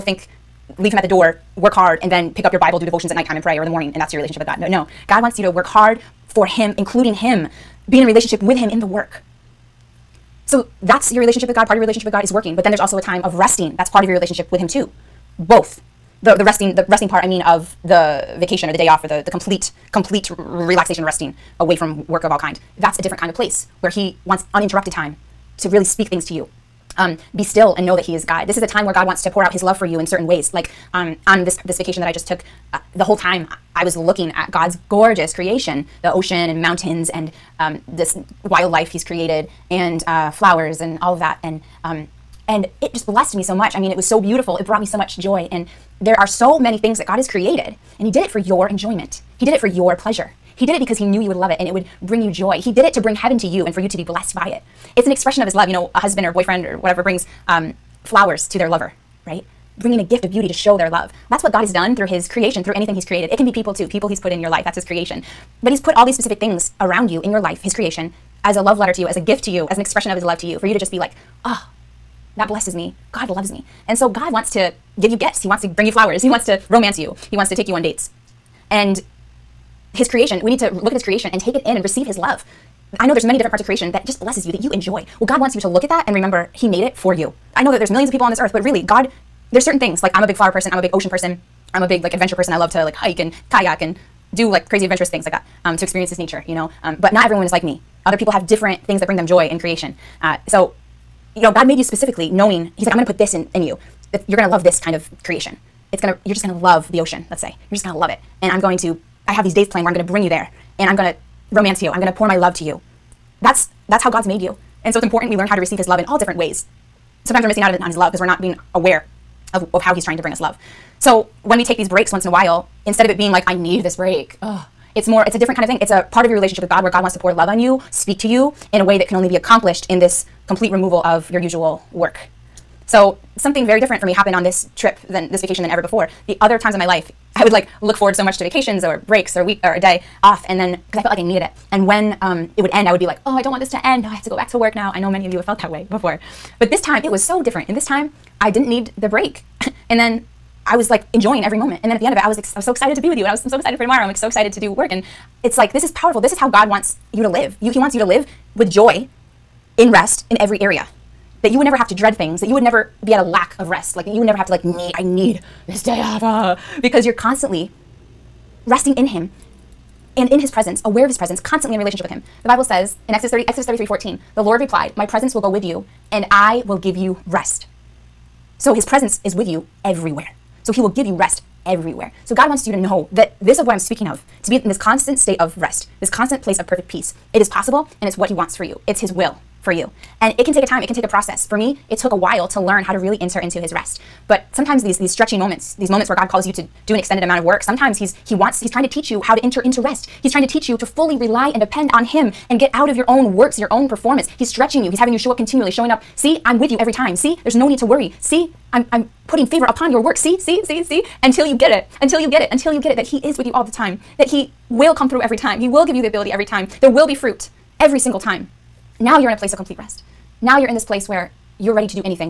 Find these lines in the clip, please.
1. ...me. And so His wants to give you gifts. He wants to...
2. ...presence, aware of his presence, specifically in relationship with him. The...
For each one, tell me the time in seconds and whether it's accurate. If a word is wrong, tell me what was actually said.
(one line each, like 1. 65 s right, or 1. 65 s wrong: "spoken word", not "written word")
1. 73 s wrong: "God", not "His"
2. 170 s wrong: "constantly", not "specifically".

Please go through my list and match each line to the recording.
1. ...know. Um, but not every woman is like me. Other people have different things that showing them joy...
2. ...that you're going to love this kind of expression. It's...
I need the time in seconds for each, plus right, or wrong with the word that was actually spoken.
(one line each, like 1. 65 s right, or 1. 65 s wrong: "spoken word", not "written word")
1. 96 s wrong: "bring", not "showing"
2. 104 s wrong: "creation", not "expression".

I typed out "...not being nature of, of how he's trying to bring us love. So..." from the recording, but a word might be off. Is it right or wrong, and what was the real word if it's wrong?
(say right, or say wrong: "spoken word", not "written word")
wrong: "aware", not "nature".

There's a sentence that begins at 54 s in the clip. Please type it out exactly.
It's an expression of His love.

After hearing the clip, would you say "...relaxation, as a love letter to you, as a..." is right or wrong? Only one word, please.
wrong.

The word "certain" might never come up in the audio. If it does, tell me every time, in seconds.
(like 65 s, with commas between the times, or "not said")
30 s, 89 s.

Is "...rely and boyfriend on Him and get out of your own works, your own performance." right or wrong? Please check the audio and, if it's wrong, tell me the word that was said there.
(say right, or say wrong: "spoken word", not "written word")
wrong: "depend", not "boyfriend".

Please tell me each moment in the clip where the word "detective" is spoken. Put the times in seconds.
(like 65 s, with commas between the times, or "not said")
not said.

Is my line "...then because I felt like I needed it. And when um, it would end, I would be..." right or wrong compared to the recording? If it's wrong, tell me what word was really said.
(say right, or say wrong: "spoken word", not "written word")
right.